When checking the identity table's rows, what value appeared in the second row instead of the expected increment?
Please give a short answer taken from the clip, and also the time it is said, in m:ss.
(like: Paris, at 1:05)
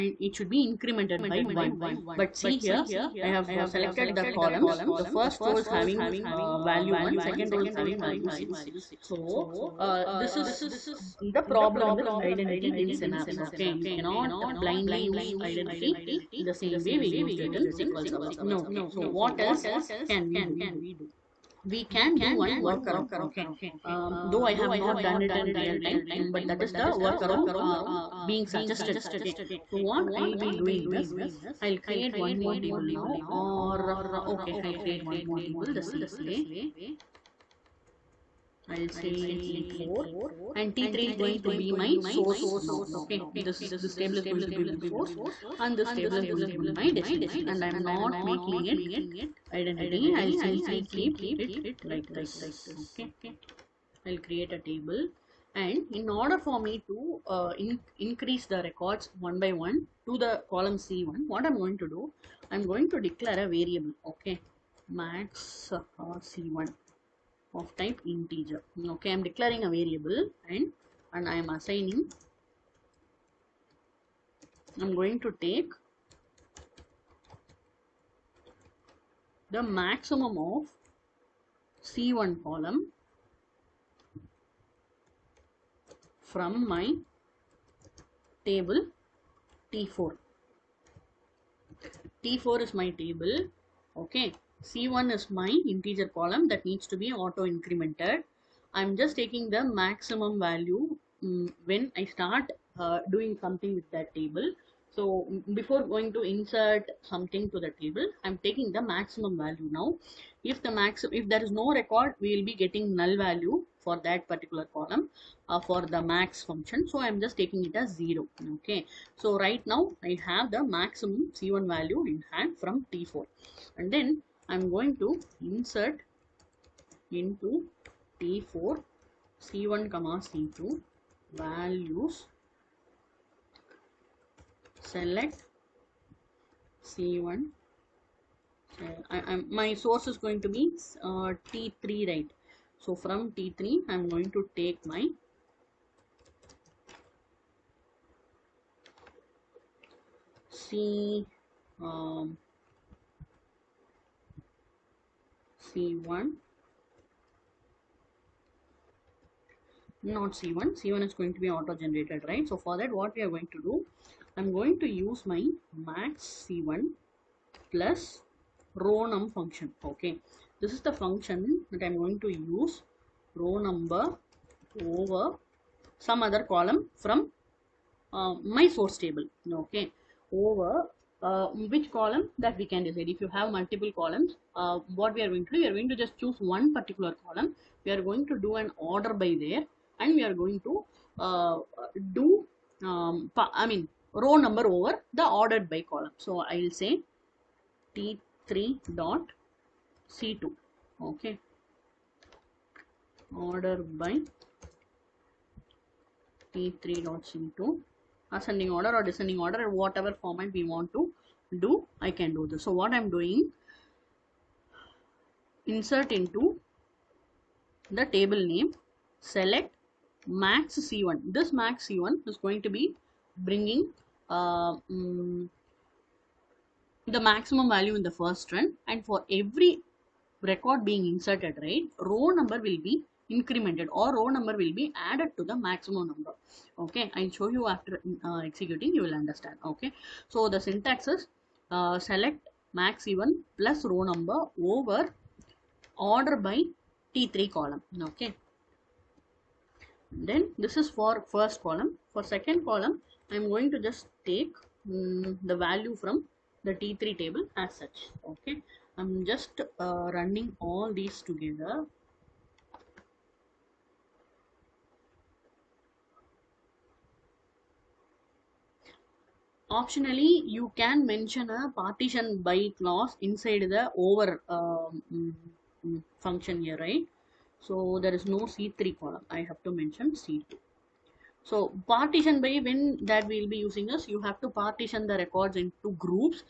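6, at 0:07.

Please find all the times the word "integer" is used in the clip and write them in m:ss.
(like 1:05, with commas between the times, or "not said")
1:08, 1:35.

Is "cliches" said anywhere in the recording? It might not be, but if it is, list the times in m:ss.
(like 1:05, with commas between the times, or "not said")
not said.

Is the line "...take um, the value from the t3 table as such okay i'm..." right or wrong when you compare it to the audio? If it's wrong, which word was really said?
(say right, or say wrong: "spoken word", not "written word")
right.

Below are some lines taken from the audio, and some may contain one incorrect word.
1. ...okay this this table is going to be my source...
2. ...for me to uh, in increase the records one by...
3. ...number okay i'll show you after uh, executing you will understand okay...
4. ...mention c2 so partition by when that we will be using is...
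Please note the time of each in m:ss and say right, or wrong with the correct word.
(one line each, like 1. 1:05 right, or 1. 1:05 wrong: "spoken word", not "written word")
1. 0:42 right
2. 0:56 right
3. 3:56 right
4. 4:39 right.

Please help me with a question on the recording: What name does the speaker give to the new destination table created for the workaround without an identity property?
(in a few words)
T4.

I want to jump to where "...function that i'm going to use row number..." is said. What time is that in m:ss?
2:51.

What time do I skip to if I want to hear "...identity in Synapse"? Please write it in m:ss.
0:12.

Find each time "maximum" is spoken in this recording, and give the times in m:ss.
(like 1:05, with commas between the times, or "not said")
1:19, 1:39, 1:48, 2:00, 3:47, 3:55.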